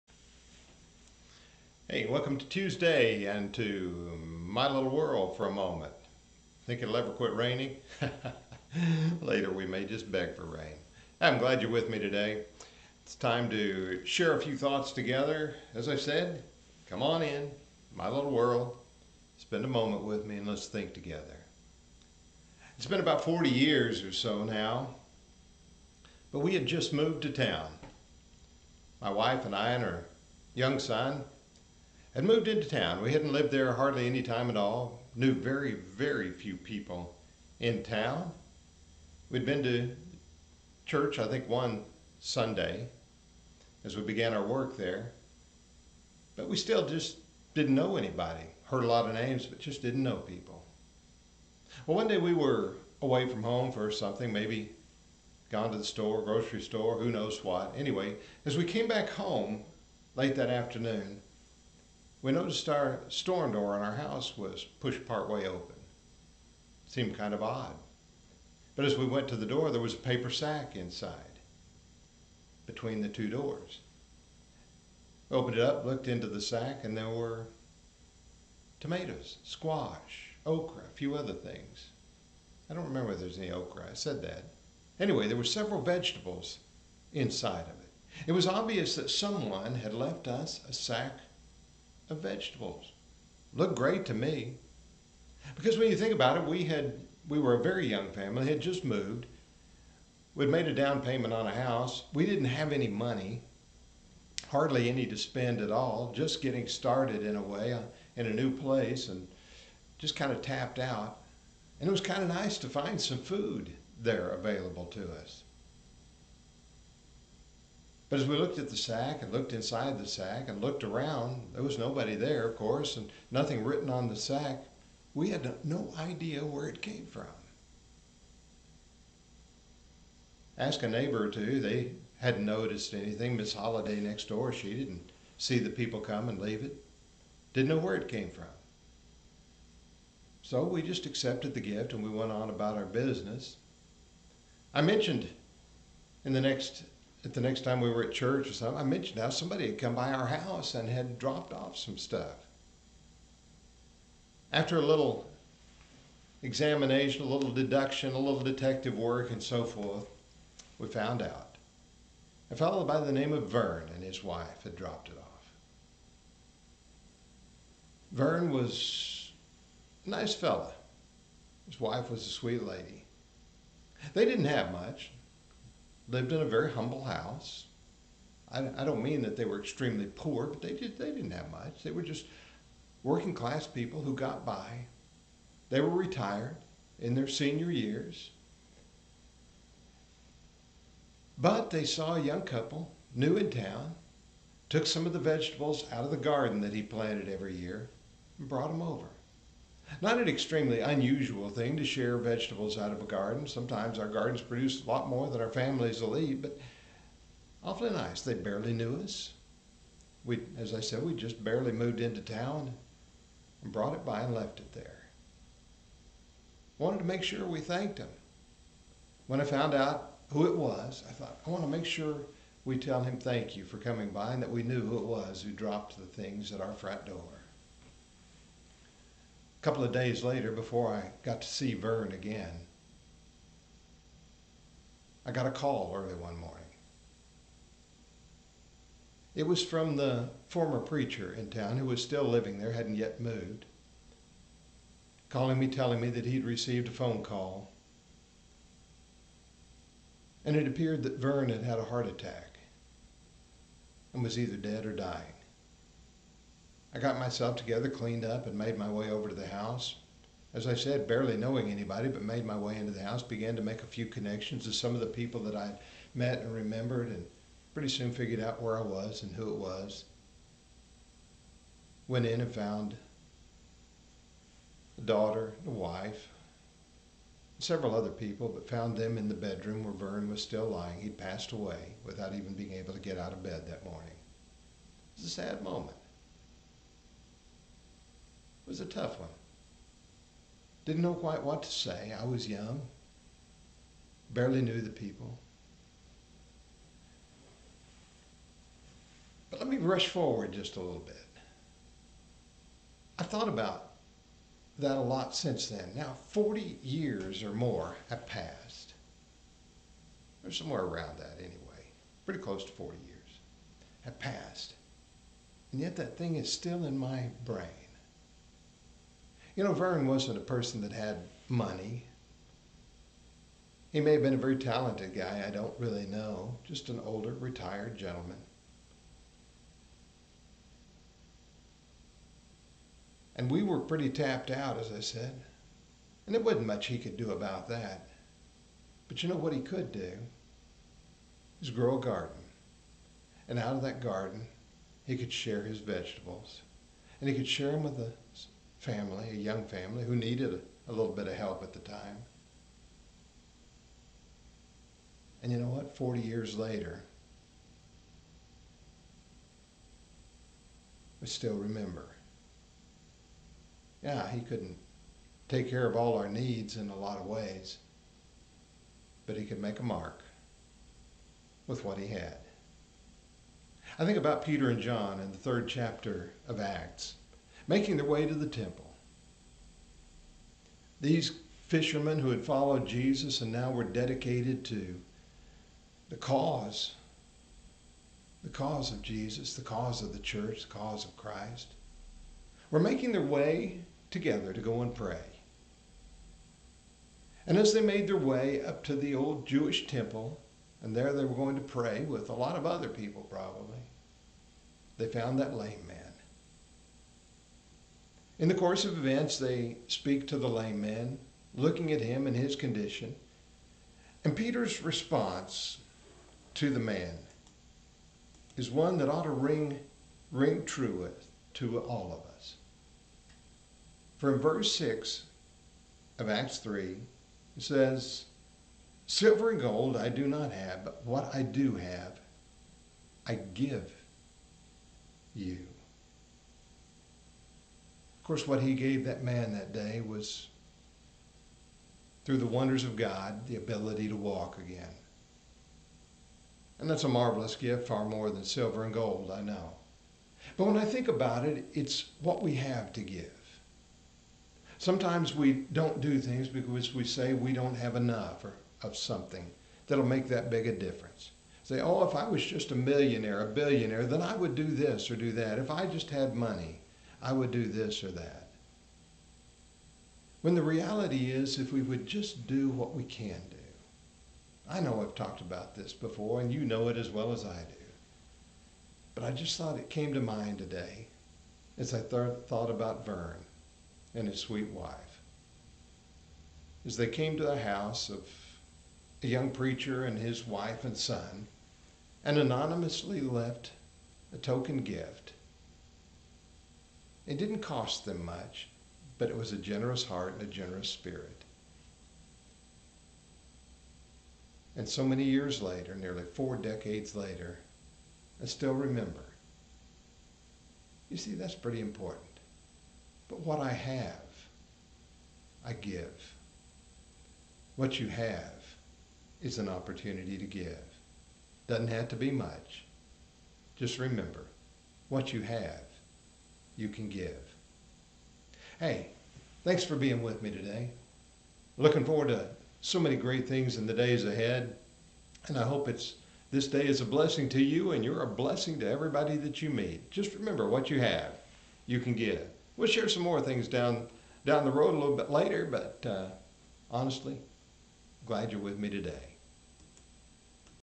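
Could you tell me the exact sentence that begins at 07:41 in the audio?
Say, oh, if I was just a millionaire, a billionaire, then I would do this or do that.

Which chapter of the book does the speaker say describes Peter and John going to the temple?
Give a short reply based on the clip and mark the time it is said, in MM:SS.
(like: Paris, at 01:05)
Third chapter, at 06:15.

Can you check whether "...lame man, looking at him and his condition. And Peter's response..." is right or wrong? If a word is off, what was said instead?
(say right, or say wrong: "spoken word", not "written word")
right.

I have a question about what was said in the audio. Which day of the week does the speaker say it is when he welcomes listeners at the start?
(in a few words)
Tuesday.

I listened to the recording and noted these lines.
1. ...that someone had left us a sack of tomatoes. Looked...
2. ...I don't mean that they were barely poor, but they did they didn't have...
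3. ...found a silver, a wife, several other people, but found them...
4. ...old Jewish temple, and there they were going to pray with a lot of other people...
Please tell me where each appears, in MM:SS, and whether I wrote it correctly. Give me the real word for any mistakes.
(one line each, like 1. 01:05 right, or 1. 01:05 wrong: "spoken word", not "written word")
1. 01:28 wrong: "vegetables", not "tomatoes"
2. 02:58 wrong: "extremely", not "barely"
3. 04:32 wrong: "daughter", not "silver"
4. 06:39 right.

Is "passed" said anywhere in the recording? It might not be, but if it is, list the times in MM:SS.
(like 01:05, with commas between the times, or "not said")
04:41, 05:08, 05:14.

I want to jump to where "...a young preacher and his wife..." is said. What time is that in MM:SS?
08:09.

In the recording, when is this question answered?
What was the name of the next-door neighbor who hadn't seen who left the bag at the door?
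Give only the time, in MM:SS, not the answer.
02:13.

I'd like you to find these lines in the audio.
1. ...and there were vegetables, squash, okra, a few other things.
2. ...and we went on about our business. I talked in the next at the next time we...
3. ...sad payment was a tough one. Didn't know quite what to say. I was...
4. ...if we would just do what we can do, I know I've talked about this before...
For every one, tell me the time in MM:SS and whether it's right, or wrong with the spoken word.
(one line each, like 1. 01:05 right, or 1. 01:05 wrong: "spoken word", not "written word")
1. 01:16 wrong: "tomatoes", not "vegetables"
2. 02:21 wrong: "mentioned", not "talked"
3. 04:45 wrong: "moment", not "payment"
4. 07:51 right.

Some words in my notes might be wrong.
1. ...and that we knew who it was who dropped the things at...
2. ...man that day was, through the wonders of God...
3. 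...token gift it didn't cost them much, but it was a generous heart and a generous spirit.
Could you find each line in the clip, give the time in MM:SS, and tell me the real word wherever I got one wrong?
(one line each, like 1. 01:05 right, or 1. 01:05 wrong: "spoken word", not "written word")
1. 03:44 right
2. 07:19 right
3. 08:14 right.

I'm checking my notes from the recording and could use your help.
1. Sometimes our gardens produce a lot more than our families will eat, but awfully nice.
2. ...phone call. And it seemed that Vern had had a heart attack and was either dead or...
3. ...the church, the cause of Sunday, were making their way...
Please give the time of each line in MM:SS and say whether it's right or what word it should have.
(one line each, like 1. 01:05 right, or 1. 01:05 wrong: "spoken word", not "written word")
1. 03:23 right
2. 04:06 wrong: "appeared", not "seemed"
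3. 06:30 wrong: "Christ", not "Sunday".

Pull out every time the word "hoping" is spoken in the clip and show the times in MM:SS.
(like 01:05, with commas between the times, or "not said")
not said.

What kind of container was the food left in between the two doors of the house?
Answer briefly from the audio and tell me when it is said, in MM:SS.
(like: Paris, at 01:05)
Paper sack, at 01:09.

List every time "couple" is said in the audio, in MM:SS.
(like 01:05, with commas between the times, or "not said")
03:12, 03:49.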